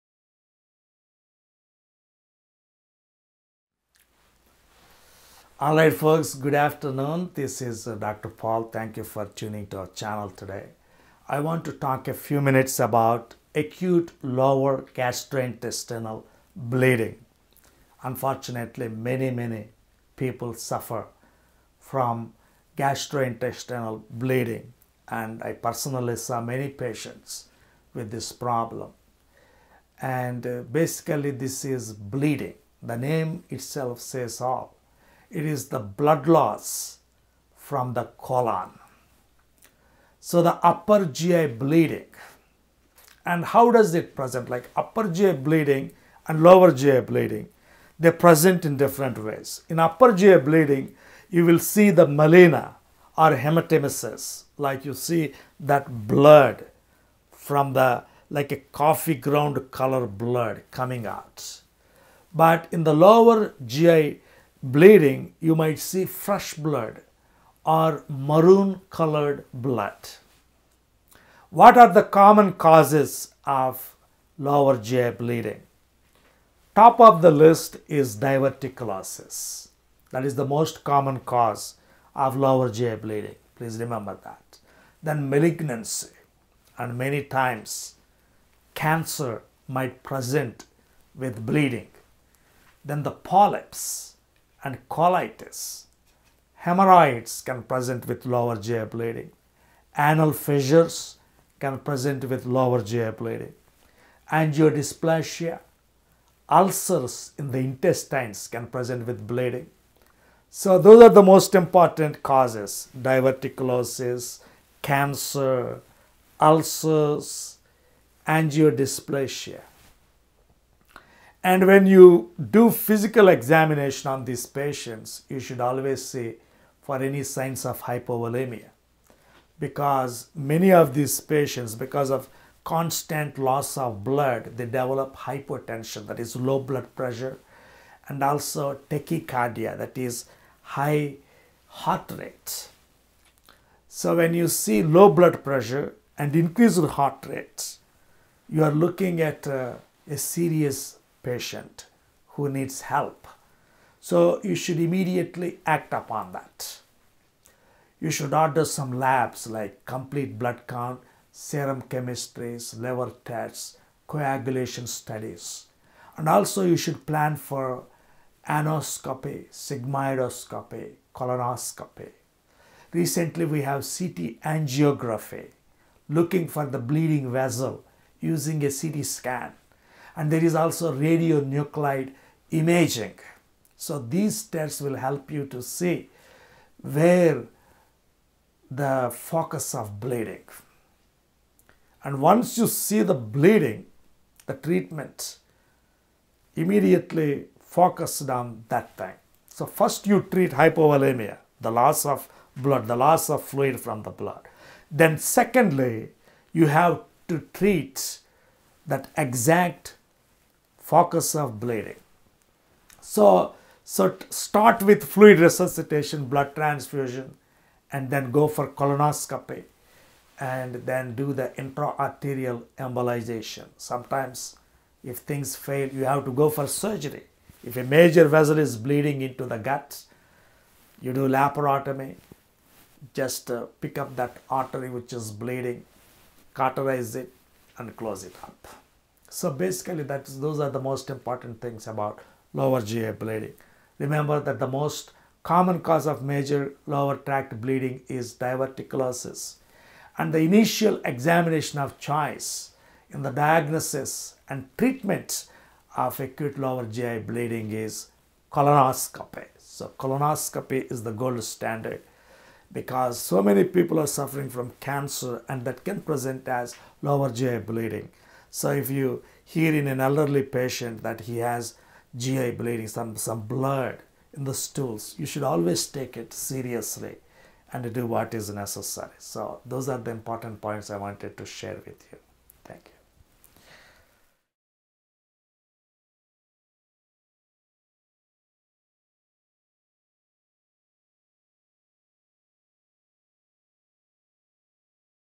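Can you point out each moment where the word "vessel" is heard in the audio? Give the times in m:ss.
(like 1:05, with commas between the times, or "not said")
2:57, 3:48.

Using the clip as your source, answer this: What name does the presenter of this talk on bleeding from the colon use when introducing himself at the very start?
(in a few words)
Dr. Paul.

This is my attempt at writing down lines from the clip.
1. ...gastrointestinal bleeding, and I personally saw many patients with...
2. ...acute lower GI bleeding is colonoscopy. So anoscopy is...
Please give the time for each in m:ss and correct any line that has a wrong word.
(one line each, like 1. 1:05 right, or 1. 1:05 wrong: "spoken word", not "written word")
1. 0:22 right
2. 4:16 wrong: "colonoscopy", not "anoscopy".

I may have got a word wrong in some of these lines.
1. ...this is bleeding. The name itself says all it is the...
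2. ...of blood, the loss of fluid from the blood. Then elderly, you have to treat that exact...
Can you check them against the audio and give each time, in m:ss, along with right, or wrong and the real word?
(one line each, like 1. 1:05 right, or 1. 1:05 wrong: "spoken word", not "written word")
1. 0:31 right
2. 3:22 wrong: "secondly", not "elderly".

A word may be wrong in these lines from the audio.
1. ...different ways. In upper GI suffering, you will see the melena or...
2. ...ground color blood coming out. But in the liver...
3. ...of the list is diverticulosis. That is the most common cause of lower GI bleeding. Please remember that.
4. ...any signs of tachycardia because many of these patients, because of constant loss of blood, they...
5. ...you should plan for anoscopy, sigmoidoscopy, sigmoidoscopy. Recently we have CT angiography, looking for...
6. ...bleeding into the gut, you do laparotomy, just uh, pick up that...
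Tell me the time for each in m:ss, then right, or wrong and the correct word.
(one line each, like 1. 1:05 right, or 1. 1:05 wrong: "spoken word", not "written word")
1. 0:48 wrong: "bleeding", not "suffering"
2. 0:59 wrong: "lower", not "liver"
3. 1:17 right
4. 2:07 wrong: "hypovolemia", not "tachycardia"
5. 2:46 wrong: "colonoscopy", not "sigmoidoscopy"
6. 3:48 right.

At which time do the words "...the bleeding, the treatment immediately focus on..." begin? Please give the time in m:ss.
3:13.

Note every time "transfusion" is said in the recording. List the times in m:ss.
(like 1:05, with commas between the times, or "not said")
3:36.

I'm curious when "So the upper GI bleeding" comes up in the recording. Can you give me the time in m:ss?
0:40.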